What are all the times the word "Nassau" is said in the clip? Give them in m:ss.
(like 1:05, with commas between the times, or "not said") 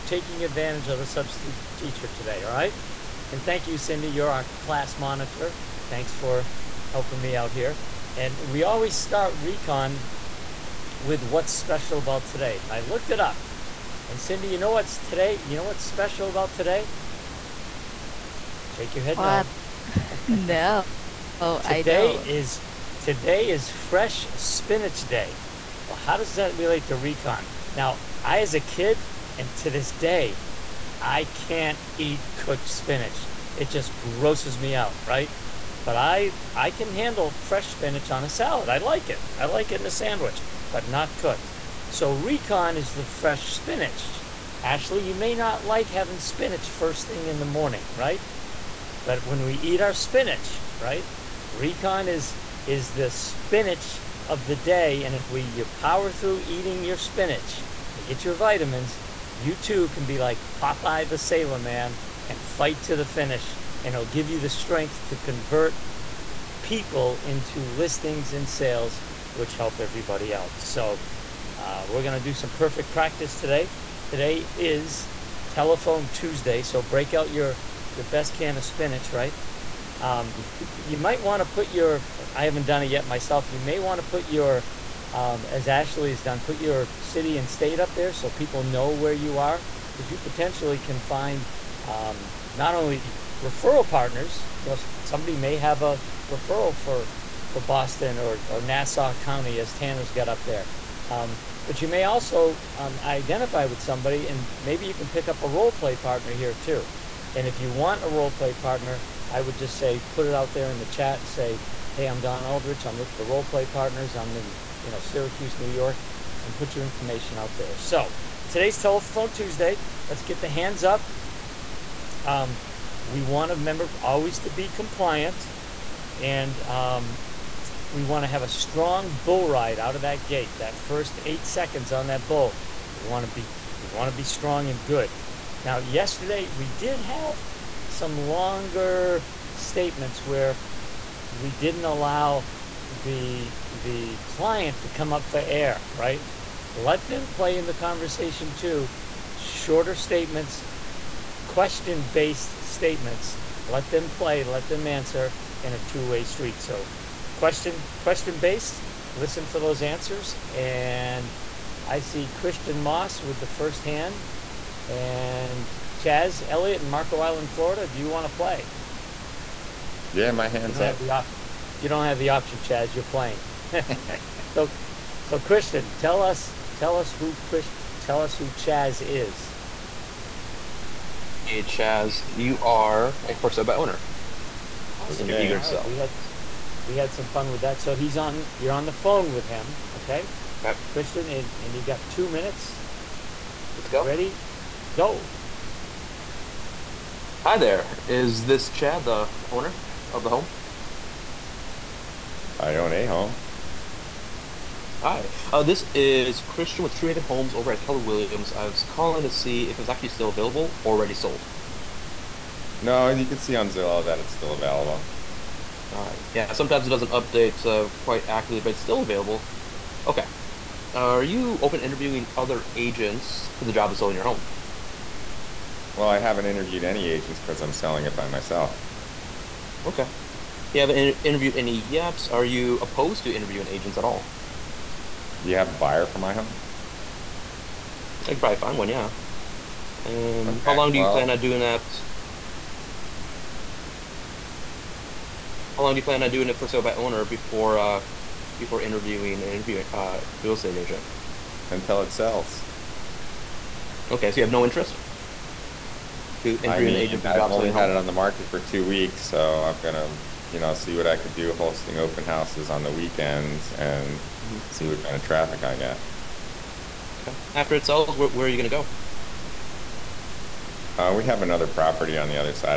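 1:38.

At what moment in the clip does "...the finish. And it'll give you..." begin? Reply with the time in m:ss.
1:02.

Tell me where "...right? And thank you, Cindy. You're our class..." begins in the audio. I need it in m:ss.
0:02.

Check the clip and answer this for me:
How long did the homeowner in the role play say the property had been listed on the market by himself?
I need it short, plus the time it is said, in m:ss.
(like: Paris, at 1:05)
2 weeks, at 4:18.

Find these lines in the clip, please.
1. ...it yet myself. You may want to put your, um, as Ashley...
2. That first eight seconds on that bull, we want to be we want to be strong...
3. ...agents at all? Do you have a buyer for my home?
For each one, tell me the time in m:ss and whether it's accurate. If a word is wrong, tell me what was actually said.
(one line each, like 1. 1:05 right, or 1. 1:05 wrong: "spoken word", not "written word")
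1. 1:22 right
2. 2:10 right
3. 3:53 right.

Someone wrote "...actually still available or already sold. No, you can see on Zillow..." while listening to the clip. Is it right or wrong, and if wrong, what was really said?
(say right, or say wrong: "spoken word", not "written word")
right.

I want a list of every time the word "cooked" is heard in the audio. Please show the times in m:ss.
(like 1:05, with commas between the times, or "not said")
0:32, 0:41.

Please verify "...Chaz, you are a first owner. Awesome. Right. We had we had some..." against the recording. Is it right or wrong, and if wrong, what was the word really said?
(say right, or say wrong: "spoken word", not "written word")
right.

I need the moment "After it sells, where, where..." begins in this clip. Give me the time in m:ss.
4:27.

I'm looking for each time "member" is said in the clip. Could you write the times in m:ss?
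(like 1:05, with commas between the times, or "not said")
2:03.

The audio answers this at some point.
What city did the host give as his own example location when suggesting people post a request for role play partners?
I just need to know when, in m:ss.
1:54.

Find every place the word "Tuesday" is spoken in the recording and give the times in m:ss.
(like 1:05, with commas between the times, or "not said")
1:16, 1:59.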